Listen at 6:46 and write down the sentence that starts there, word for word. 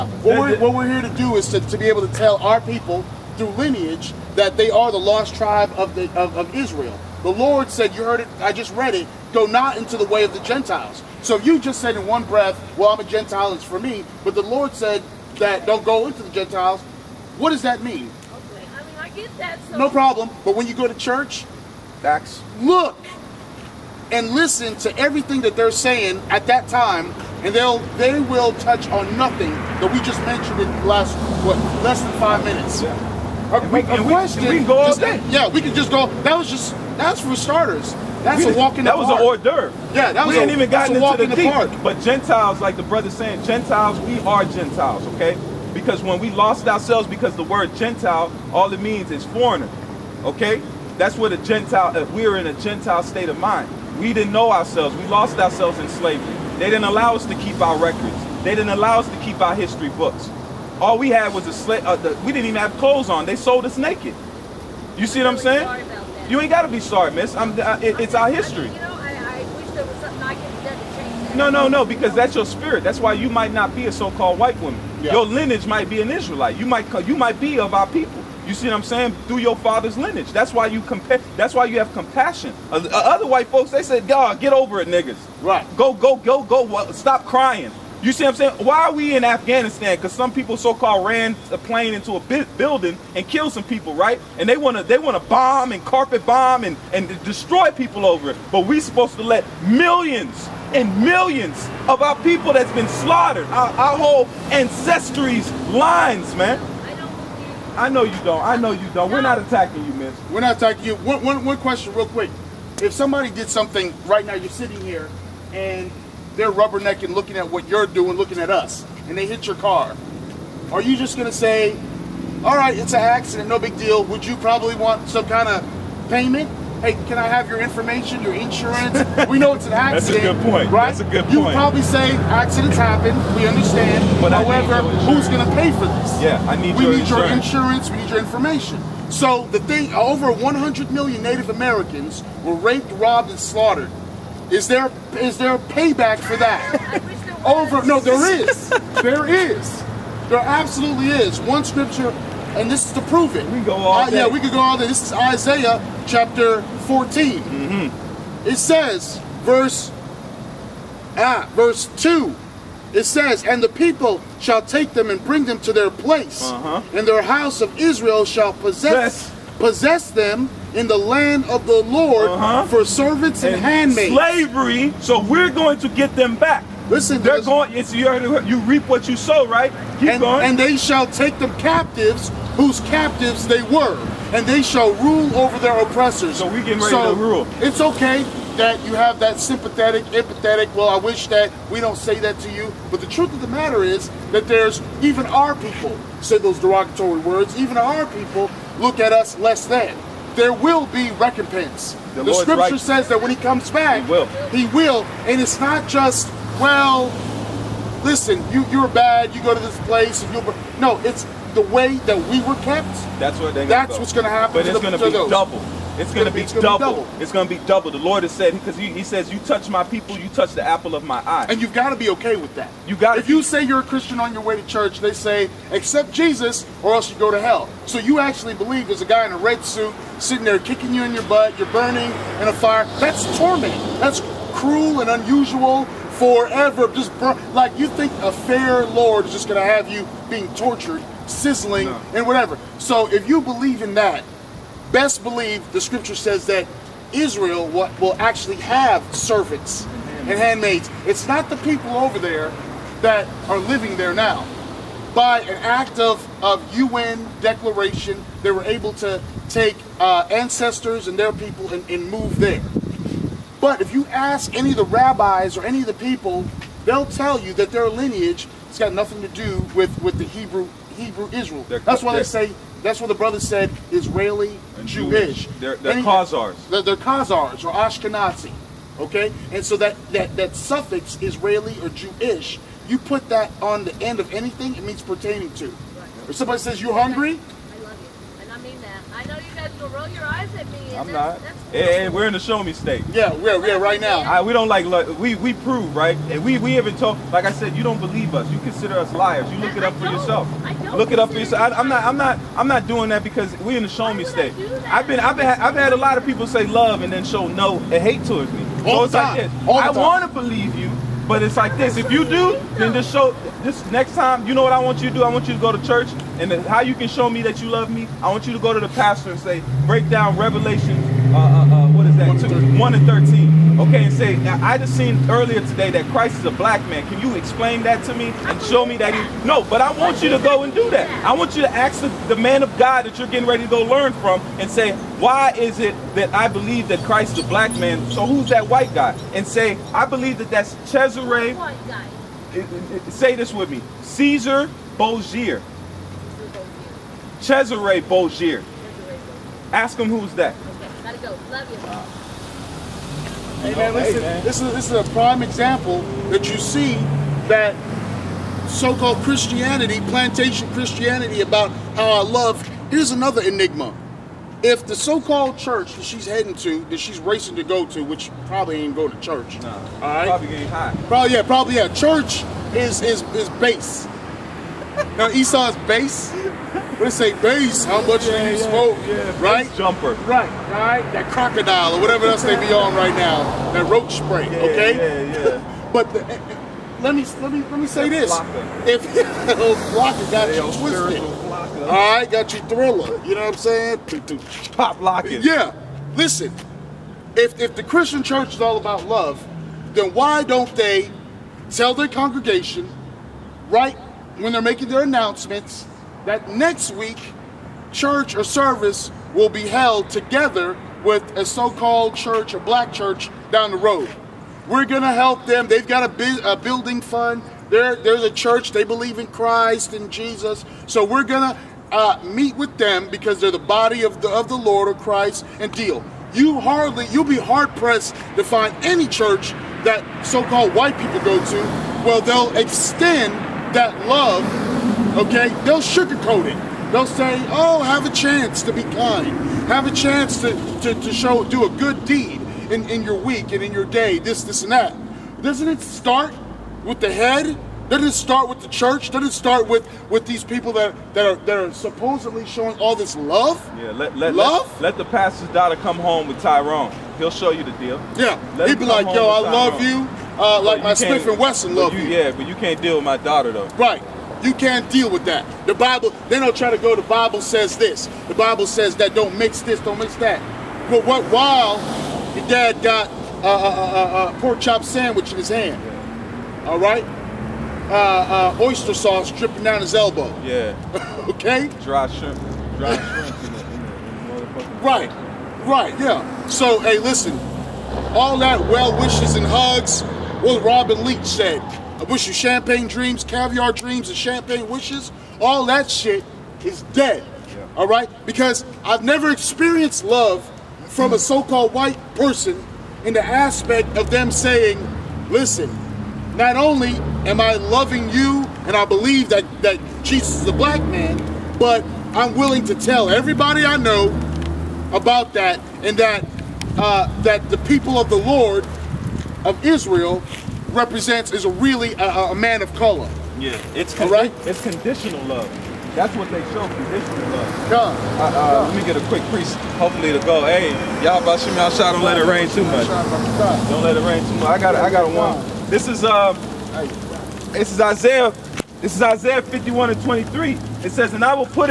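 that next week church or service will be held together with a so-called church, a black church down the road.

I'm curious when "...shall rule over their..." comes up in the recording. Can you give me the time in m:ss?
3:04.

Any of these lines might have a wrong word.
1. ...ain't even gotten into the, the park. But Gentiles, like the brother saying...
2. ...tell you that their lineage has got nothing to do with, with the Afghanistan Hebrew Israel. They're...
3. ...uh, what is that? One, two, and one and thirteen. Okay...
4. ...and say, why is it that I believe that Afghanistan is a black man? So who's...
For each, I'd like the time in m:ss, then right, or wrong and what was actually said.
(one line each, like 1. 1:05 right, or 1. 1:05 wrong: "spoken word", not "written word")
1. 0:40 right
2. 4:27 wrong: "Hebrew", not "Afghanistan"
3. 5:21 right
4. 5:34 wrong: "Christ", not "Afghanistan".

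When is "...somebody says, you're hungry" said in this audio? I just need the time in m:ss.
4:46.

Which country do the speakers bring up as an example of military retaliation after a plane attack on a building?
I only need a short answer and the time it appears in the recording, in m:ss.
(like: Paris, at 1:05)
Afghanistan, at 1:29.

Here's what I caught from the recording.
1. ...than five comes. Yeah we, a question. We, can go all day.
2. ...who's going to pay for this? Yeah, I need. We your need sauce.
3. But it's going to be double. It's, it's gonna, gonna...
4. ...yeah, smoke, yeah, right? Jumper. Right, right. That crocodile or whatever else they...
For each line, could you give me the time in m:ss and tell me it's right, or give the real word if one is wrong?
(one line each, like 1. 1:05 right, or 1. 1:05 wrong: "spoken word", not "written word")
1. 0:32 wrong: "minutes", not "comes"
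2. 2:15 wrong: "insurance", not "sauce"
3. 3:34 right
4. 6:18 right.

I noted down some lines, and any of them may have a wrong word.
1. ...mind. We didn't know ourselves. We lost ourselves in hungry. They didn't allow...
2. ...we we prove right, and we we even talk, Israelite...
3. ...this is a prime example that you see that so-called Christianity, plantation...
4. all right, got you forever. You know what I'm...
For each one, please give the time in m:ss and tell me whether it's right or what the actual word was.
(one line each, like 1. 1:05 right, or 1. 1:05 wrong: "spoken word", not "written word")
1. 0:53 wrong: "slavery", not "hungry"
2. 4:55 wrong: "Like", not "Israelite"
3. 5:54 right
4. 6:31 wrong: "thriller", not "forever".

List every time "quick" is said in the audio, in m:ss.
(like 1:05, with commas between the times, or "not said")
1:52, 8:49.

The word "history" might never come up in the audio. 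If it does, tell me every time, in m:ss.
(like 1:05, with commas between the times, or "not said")
0:59, 1:08.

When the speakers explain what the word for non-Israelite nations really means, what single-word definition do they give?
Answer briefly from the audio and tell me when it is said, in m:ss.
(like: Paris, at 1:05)
foreigner, at 0:49.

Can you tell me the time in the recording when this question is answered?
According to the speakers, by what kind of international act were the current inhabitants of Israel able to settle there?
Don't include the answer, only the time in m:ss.
4:16.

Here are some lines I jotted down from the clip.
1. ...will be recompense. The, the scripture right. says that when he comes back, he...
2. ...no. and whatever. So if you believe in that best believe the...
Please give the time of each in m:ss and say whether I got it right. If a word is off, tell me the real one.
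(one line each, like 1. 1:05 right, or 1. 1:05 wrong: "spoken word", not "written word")
1. 3:20 right
2. 4:01 right.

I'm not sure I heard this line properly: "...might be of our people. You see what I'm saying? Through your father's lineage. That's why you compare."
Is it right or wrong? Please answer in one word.
right.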